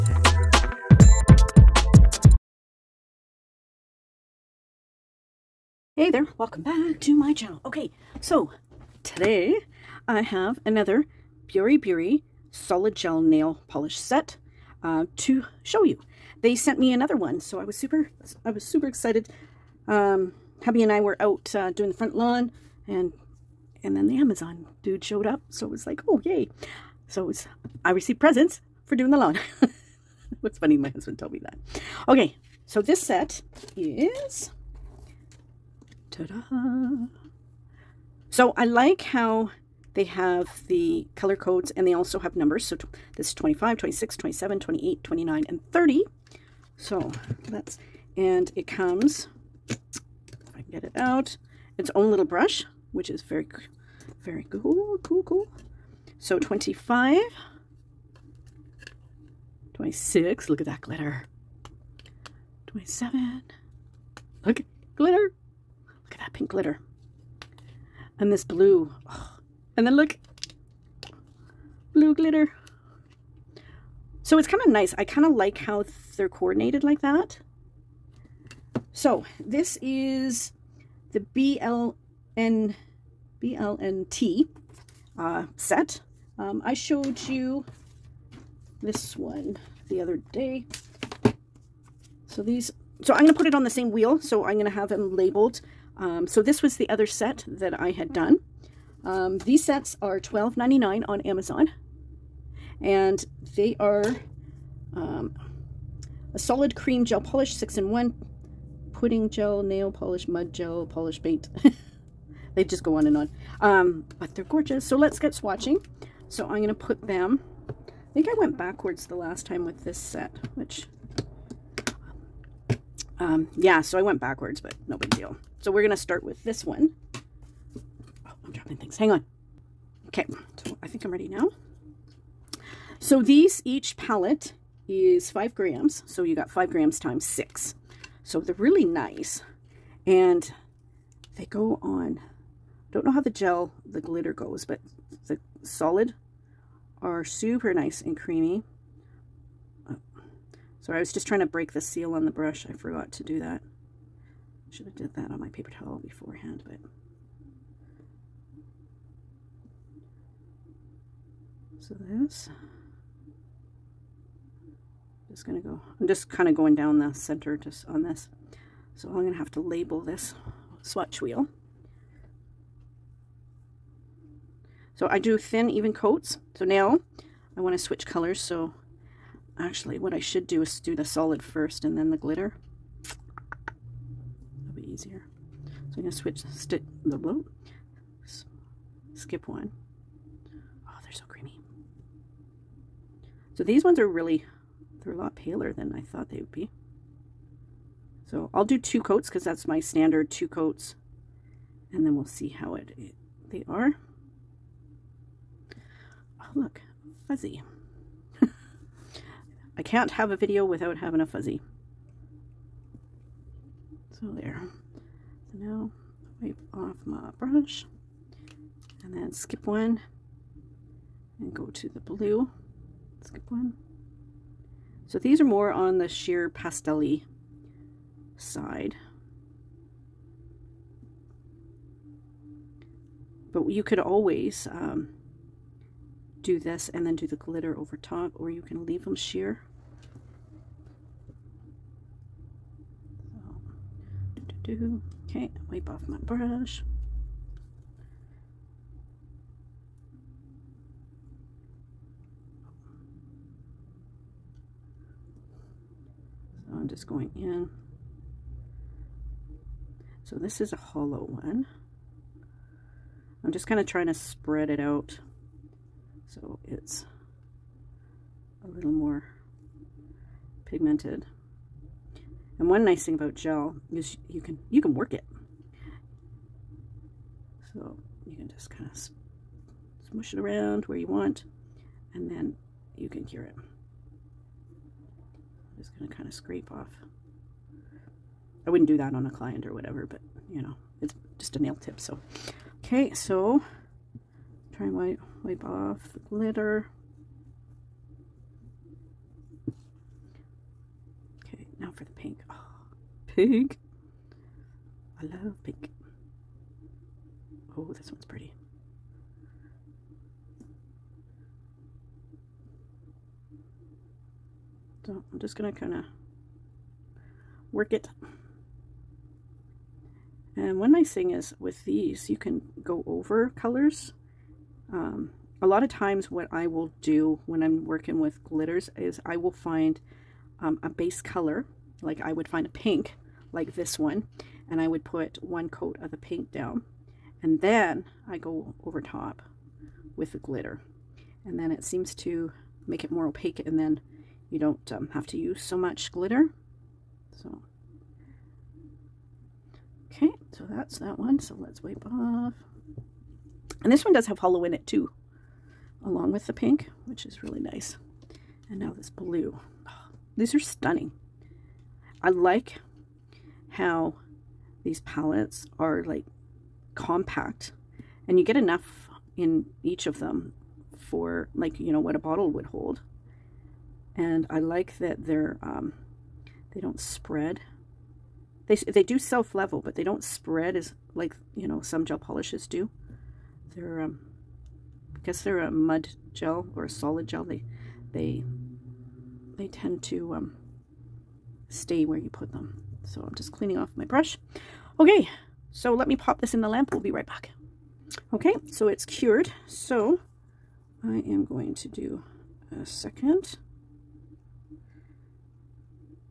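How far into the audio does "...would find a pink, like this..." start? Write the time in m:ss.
5:32.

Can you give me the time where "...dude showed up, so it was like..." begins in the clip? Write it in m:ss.
0:24.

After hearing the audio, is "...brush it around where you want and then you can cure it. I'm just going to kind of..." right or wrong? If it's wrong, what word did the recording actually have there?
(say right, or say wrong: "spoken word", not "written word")
wrong: "smush", not "brush".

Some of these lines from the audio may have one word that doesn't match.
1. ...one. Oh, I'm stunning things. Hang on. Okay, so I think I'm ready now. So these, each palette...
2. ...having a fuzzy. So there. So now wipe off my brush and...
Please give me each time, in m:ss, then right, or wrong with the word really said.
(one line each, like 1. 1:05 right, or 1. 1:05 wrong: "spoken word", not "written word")
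1. 2:06 wrong: "dropping", not "stunning"
2. 3:30 right.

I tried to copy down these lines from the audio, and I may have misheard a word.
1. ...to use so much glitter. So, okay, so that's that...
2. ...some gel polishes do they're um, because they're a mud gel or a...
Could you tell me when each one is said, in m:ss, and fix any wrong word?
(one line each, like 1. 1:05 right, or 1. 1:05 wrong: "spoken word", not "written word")
1. 5:45 right
2. 6:21 right.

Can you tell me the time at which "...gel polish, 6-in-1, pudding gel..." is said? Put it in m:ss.
1:47.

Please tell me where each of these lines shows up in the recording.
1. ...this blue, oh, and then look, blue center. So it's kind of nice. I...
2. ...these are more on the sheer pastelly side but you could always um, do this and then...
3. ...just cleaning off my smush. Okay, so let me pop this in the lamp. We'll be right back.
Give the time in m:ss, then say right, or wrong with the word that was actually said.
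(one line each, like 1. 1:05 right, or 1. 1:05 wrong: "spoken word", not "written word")
1. 1:08 wrong: "glitter", not "center"
2. 3:45 right
3. 6:33 wrong: "brush", not "smush".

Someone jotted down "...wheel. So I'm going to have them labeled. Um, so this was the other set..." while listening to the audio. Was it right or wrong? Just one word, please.
right.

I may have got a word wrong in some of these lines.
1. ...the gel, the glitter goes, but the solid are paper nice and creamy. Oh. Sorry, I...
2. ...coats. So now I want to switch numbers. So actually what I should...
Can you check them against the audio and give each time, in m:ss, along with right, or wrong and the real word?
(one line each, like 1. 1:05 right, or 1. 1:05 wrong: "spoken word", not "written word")
1. 2:23 wrong: "super", not "paper"
2. 2:55 wrong: "colors", not "numbers".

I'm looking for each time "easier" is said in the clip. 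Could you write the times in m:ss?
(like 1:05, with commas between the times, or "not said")
3:04.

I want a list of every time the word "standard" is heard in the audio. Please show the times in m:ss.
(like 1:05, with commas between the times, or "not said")
3:19.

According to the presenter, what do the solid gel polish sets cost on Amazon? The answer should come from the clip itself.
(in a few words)
$12.99.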